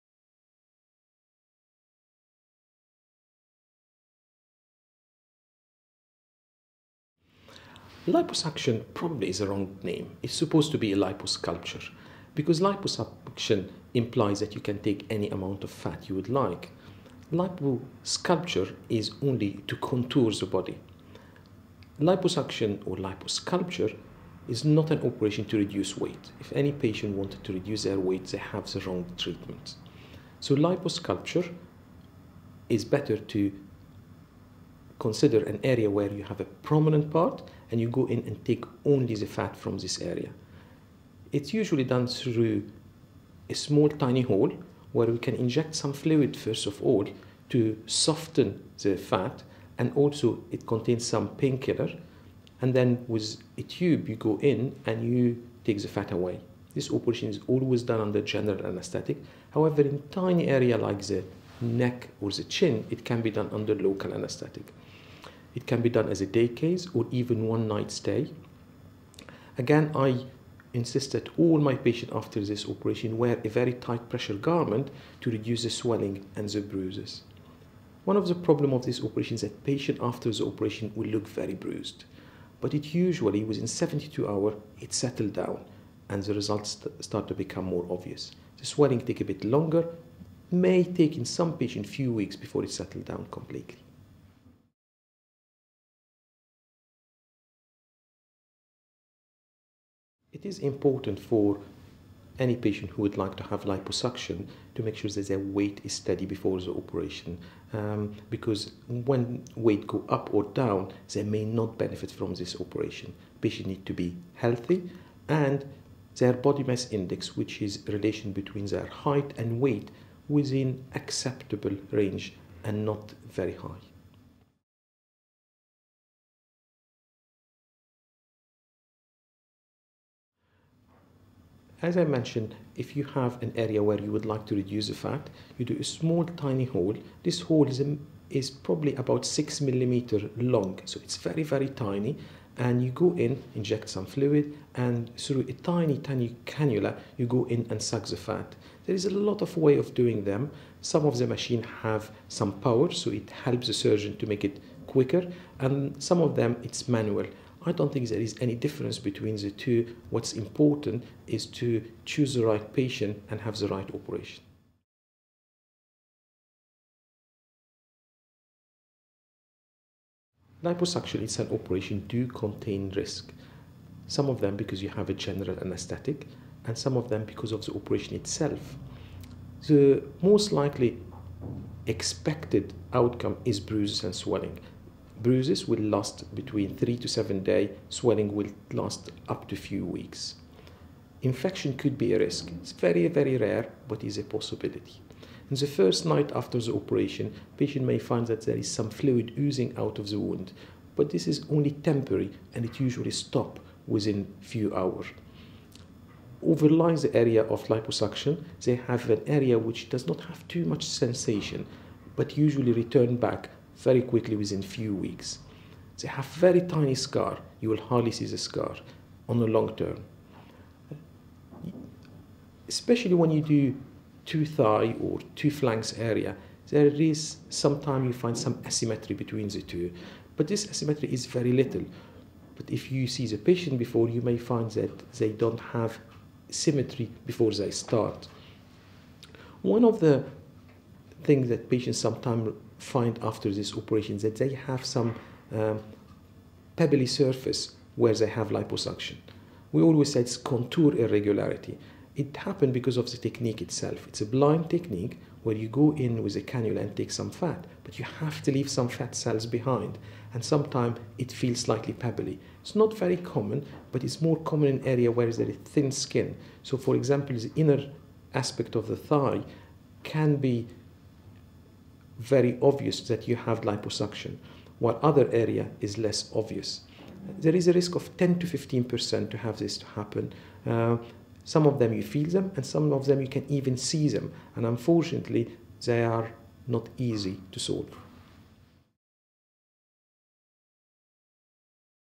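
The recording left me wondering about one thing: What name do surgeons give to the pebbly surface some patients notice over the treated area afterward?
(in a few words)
contour irregularity.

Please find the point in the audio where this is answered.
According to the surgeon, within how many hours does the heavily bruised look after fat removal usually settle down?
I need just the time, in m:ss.
1:23.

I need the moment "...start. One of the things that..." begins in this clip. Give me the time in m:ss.
3:57.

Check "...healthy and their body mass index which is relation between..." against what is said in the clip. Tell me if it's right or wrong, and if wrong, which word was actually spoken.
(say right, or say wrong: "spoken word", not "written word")
right.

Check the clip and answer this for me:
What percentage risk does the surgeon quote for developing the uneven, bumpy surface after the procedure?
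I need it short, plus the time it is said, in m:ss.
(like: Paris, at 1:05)
10 to 15 percent, at 4:38.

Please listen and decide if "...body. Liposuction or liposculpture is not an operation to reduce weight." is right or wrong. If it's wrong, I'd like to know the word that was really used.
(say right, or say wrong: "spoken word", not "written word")
right.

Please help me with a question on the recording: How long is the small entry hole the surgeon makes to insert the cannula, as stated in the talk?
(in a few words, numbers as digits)
6 millimeter.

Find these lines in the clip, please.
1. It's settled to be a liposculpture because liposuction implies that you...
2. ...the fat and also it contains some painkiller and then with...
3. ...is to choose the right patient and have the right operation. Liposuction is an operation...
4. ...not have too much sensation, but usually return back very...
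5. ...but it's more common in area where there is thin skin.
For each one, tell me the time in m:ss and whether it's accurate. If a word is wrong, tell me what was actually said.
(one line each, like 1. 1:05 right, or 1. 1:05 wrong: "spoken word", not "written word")
1. 0:10 wrong: "supposed", not "settled"
2. 0:48 right
3. 2:41 right
4. 3:30 right
5. 4:23 right.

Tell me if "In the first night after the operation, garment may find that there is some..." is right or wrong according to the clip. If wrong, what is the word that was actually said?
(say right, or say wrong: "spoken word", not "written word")
wrong: "patient", not "garment".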